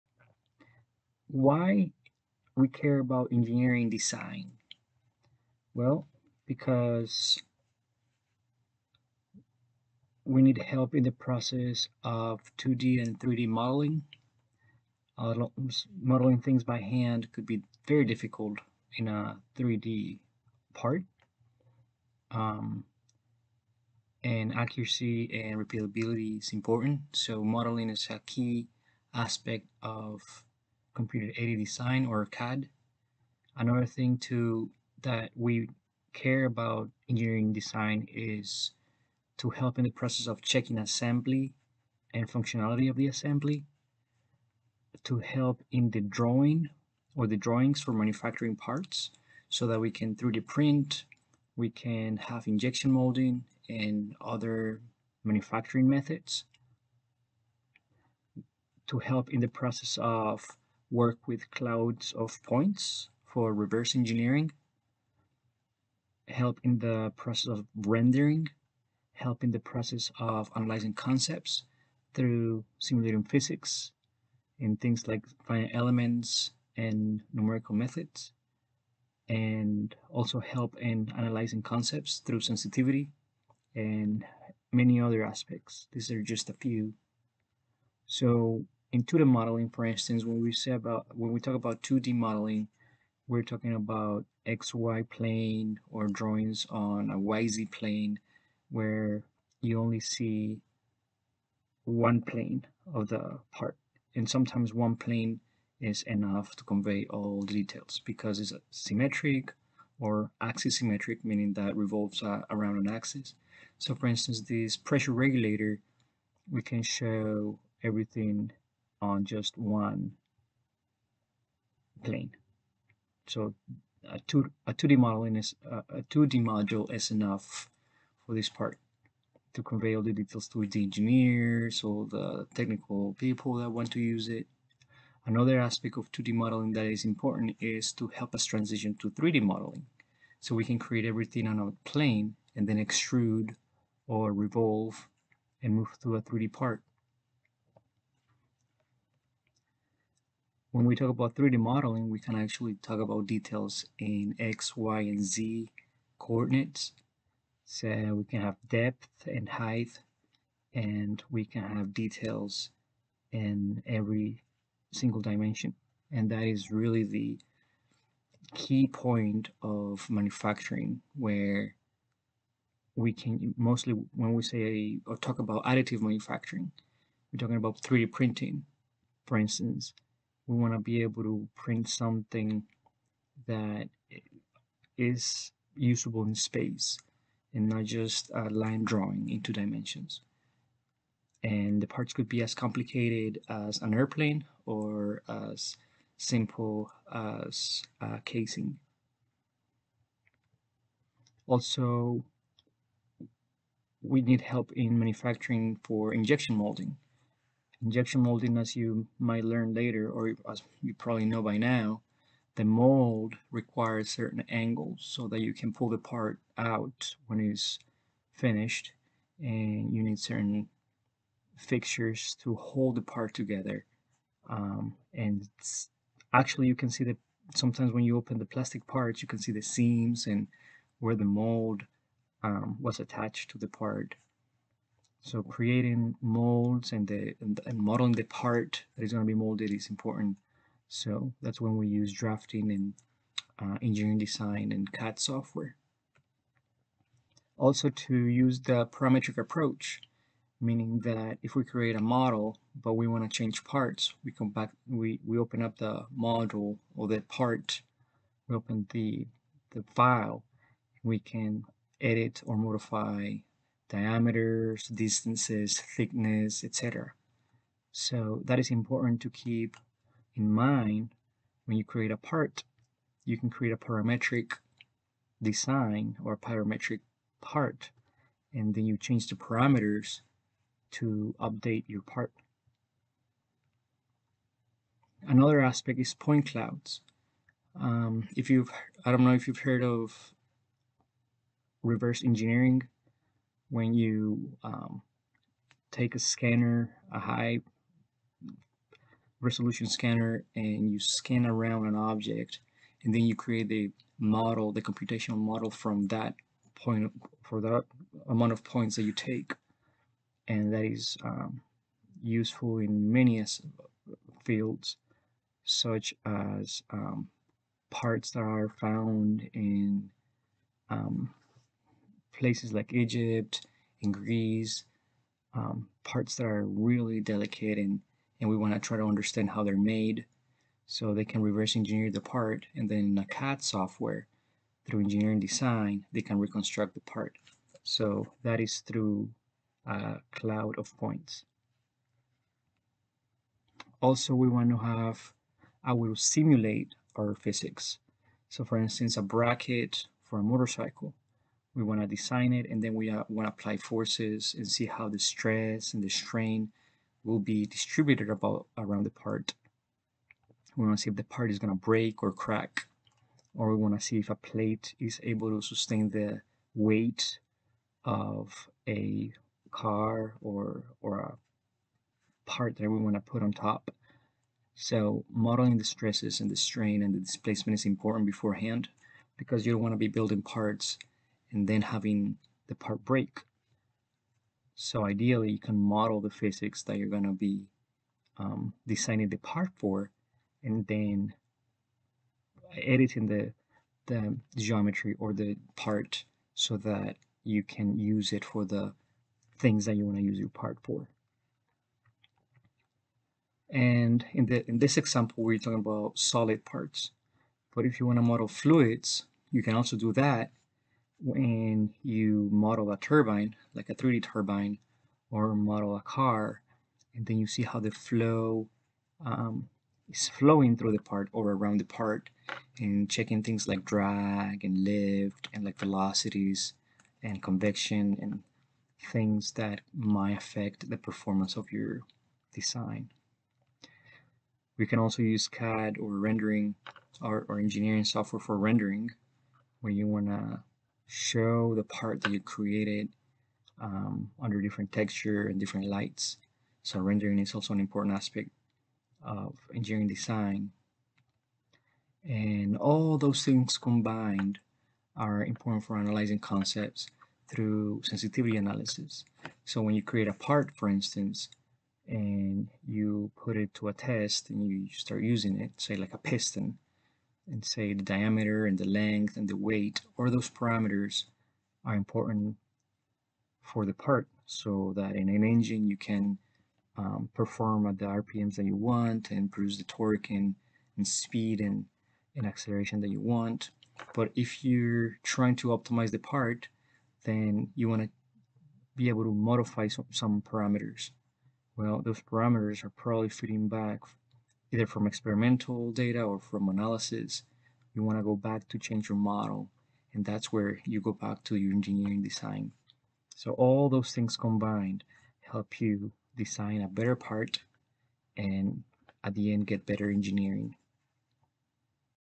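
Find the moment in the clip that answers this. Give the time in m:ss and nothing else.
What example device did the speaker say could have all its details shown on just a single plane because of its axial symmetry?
1:54.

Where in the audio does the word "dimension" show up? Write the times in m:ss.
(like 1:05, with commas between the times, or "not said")
2:45, 3:09.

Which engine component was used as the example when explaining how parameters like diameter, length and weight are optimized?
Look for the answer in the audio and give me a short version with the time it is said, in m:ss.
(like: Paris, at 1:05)
piston, at 7:46.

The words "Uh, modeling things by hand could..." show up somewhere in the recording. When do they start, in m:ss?
0:15.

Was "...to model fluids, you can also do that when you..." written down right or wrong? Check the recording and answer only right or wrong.
right.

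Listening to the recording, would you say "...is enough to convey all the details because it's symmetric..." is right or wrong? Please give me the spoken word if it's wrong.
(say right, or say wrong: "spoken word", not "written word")
right.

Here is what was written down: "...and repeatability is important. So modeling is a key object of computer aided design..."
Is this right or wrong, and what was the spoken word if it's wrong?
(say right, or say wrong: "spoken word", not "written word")
wrong: "aspect", not "object".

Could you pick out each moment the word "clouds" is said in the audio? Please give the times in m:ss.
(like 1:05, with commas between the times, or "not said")
1:01, 4:46, 5:40.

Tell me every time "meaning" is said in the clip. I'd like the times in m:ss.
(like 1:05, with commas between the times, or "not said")
1:51, 4:10.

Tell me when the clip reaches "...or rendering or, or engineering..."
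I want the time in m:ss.
7:15.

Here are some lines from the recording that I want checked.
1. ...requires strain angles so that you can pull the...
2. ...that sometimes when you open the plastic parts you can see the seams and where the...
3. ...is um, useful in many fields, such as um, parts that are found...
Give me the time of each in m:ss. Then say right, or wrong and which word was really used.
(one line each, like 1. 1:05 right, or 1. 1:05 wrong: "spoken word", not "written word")
1. 3:33 wrong: "certain", not "strain"
2. 3:47 right
3. 5:10 right.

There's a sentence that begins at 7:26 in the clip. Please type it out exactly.
So rendering is also an important aspect of engineering design.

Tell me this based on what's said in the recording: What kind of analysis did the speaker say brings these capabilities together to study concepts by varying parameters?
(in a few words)
sensitivity analysis.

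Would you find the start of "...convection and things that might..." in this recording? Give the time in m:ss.
7:07.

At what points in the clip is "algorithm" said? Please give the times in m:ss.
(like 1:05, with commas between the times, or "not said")
not said.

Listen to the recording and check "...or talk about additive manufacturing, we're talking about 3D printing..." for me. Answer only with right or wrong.
right.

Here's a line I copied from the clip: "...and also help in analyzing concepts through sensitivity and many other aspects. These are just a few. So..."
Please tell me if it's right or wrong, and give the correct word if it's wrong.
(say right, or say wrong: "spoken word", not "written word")
right.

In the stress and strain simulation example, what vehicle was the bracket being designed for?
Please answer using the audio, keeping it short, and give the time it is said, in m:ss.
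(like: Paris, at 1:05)
motorcycle, at 5:50.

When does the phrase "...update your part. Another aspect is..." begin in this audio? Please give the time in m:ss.
4:41.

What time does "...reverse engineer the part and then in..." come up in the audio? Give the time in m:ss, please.
5:31.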